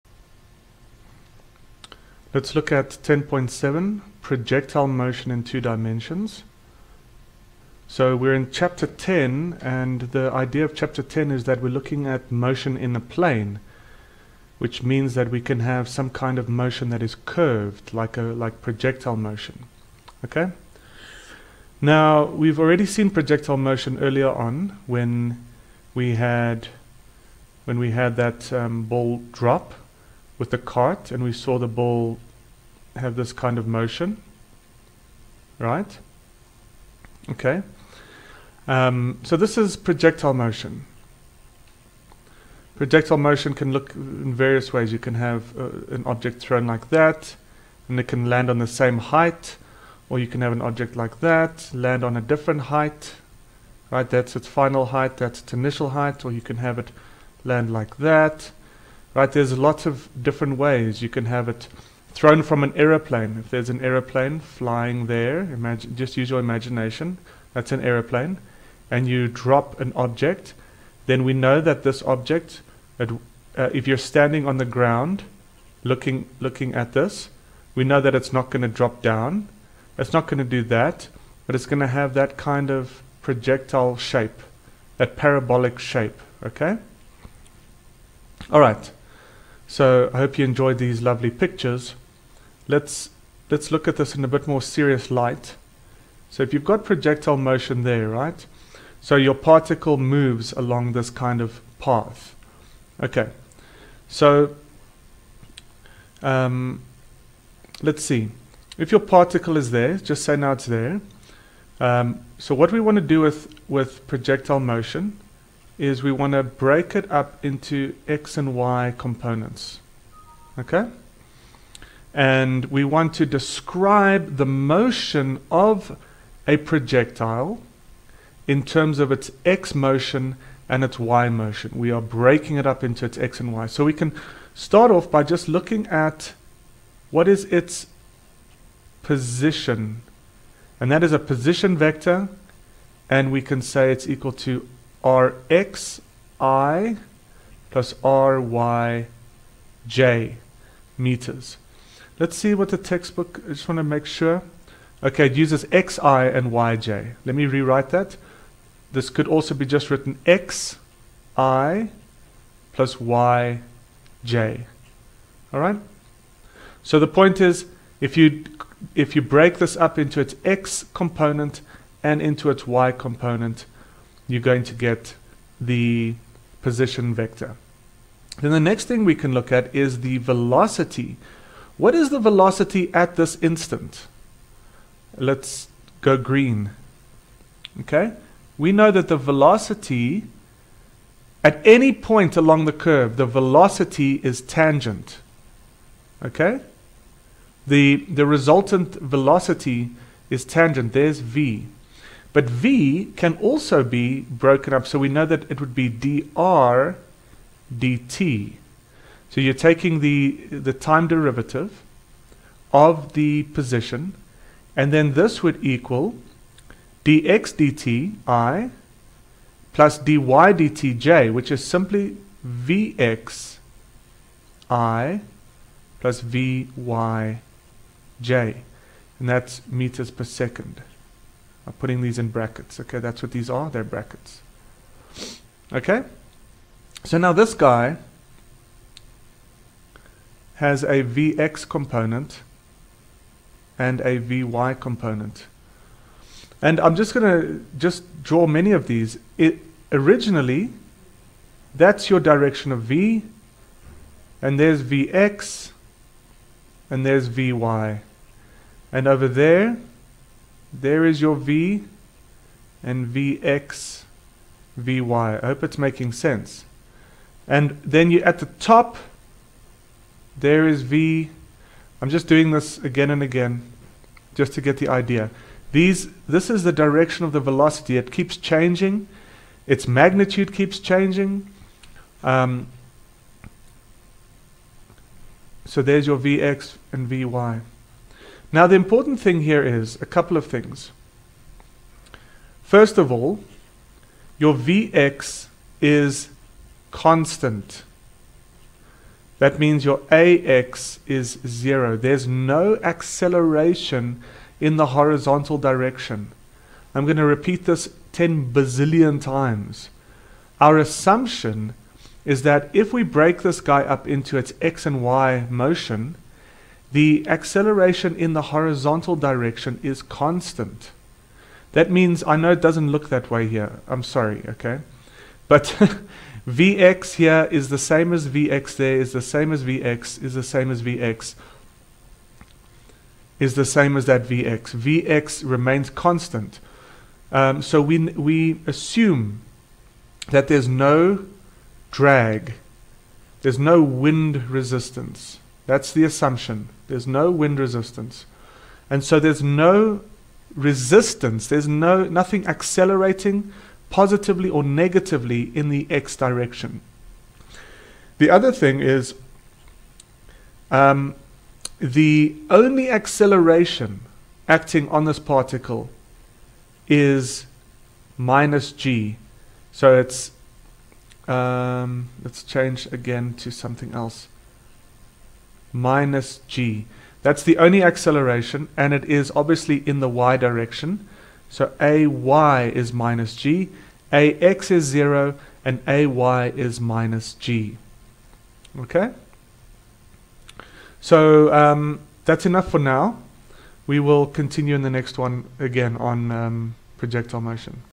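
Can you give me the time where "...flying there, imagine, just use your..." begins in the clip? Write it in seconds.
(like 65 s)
64 s.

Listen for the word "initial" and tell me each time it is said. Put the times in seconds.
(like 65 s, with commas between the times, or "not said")
55 s.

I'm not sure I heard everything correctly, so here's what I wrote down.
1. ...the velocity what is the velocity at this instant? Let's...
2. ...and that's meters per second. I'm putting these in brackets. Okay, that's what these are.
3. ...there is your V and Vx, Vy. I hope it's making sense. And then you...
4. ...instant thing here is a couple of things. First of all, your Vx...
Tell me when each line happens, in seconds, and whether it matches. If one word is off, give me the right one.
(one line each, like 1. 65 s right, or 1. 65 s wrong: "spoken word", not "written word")
1. 180 s right
2. 229 s right
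3. 260 s right
4. 288 s wrong: "important", not "instant".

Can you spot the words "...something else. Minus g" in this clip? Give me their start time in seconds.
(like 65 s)
373 s.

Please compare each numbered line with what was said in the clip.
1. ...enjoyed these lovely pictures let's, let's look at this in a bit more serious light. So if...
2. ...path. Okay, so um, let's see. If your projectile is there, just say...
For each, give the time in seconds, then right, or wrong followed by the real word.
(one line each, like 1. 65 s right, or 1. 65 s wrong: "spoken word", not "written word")
1. 90 s right
2. 101 s wrong: "particle", not "projectile".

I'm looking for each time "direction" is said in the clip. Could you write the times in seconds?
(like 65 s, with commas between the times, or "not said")
252 s, 276 s, 305 s, 319 s, 356 s, 380 s.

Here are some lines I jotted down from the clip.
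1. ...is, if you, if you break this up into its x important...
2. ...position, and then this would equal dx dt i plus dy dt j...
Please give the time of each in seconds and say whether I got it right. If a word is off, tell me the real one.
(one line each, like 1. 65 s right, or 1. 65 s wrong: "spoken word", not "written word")
1. 167 s wrong: "component", not "important"
2. 213 s right.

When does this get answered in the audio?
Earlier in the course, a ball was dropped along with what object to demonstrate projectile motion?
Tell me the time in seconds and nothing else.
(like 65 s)
30 s.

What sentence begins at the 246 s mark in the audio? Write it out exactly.
And I'm just going to just draw many of these.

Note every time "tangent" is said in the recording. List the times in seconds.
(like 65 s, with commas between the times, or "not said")
194 s, 200 s.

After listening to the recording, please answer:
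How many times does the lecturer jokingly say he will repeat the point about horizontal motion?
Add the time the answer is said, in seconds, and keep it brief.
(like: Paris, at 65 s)
10 bazillion, at 308 s.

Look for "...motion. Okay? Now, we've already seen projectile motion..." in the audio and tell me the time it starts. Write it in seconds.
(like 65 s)
19 s.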